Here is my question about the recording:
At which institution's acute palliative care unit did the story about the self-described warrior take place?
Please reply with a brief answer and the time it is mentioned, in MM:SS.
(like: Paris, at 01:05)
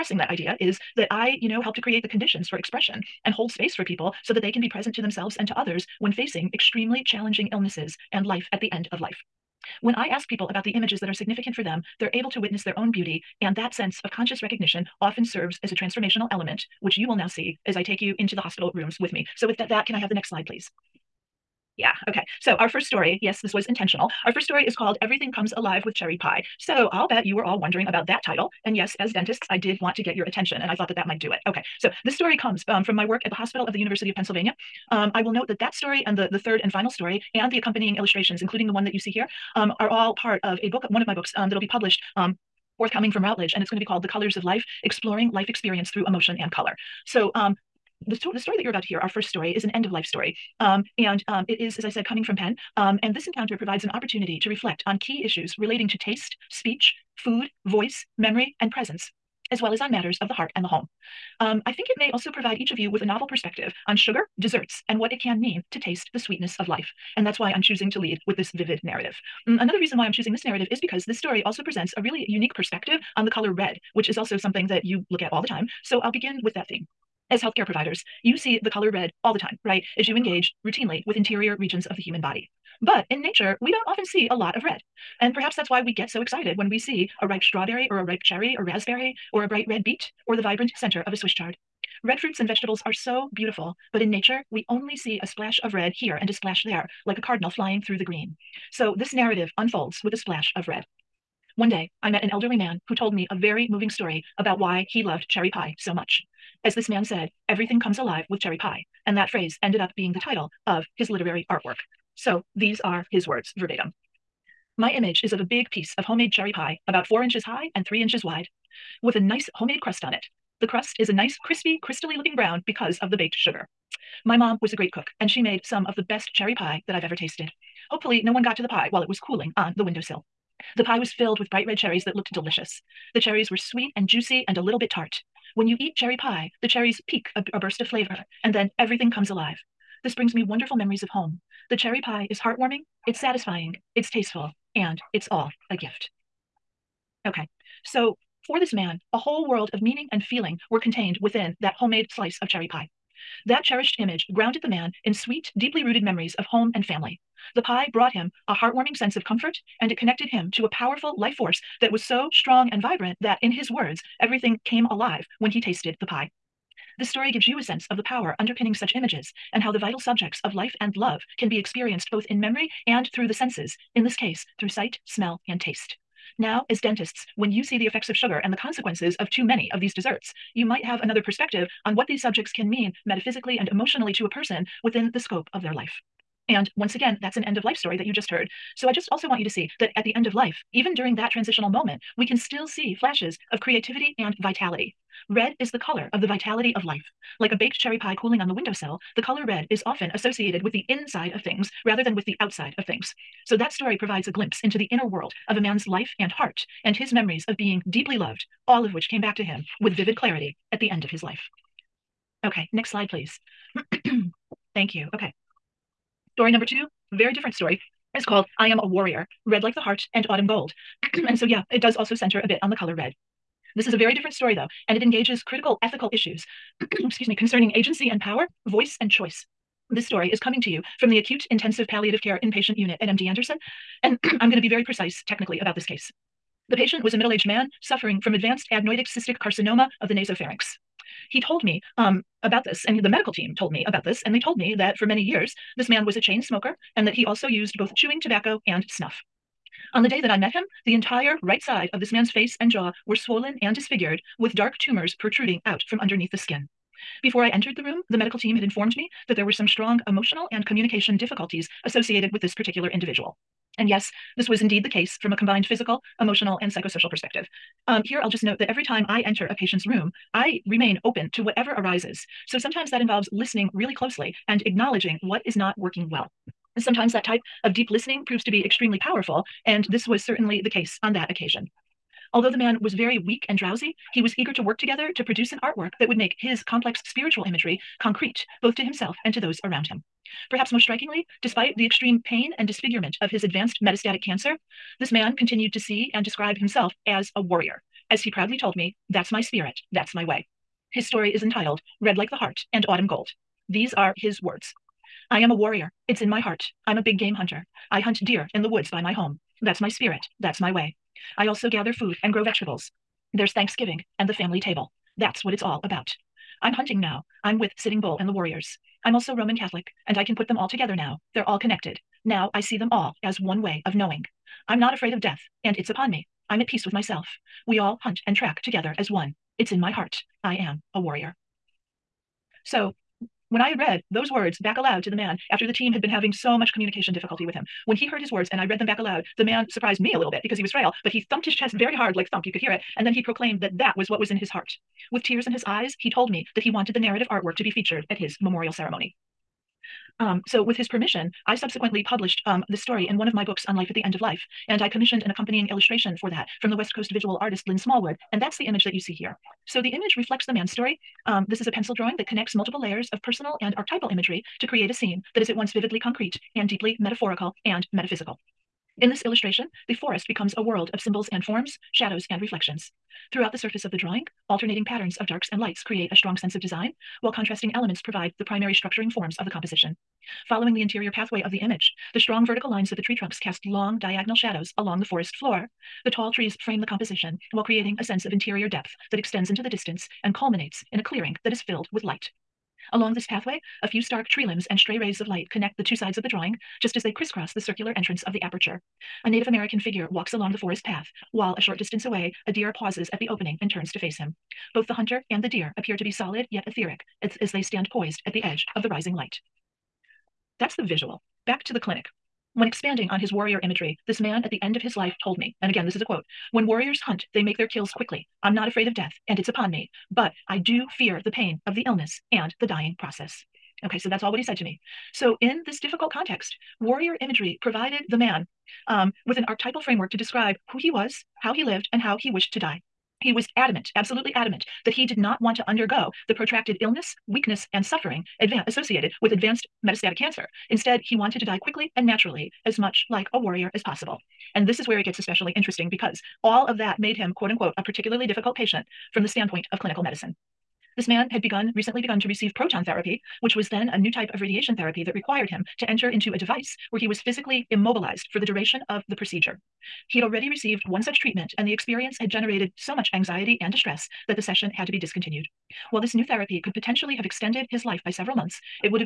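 MD Anderson, at 03:53.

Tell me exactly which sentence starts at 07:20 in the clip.
Instead, he wanted to die quickly and naturally, as much like a warrior as possible.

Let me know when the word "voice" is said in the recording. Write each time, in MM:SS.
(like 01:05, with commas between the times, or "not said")
00:57, 03:48.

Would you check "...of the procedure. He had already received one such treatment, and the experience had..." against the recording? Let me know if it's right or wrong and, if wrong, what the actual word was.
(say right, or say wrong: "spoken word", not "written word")
right.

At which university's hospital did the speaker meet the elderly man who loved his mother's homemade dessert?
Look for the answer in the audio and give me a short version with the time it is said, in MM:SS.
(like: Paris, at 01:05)
University of Pennsylvania, at 00:33.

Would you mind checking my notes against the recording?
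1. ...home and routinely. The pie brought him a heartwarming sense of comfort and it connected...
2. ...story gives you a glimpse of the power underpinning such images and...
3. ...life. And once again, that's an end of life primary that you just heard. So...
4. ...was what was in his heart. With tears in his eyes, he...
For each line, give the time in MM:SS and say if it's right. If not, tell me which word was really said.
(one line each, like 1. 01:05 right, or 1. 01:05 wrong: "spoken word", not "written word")
1. 02:36 wrong: "family", not "routinely"
2. 02:47 wrong: "sense", not "glimpse"
3. 03:05 wrong: "story", not "primary"
4. 05:43 right.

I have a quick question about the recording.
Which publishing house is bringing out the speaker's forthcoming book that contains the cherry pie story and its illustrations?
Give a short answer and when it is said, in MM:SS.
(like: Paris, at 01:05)
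Routledge, at 00:43.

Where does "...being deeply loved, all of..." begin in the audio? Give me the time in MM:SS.
03:27.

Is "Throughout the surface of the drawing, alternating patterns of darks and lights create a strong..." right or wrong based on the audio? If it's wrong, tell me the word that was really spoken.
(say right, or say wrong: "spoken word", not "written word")
right.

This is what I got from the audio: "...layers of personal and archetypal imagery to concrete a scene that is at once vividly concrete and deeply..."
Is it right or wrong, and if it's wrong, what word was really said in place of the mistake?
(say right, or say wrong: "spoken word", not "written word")
wrong: "create", not "concrete".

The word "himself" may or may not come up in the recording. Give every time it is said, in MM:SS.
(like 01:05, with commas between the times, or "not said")
04:48, 04:56.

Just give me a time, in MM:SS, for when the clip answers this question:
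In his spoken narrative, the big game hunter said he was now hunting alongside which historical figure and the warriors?
05:17.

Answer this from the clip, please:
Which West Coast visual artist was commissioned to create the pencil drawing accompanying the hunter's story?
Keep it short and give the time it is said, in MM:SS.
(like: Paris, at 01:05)
Lynn Smallwood, at 05:57.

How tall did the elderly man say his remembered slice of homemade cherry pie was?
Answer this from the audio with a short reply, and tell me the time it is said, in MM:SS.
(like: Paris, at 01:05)
4 inches, at 01:57.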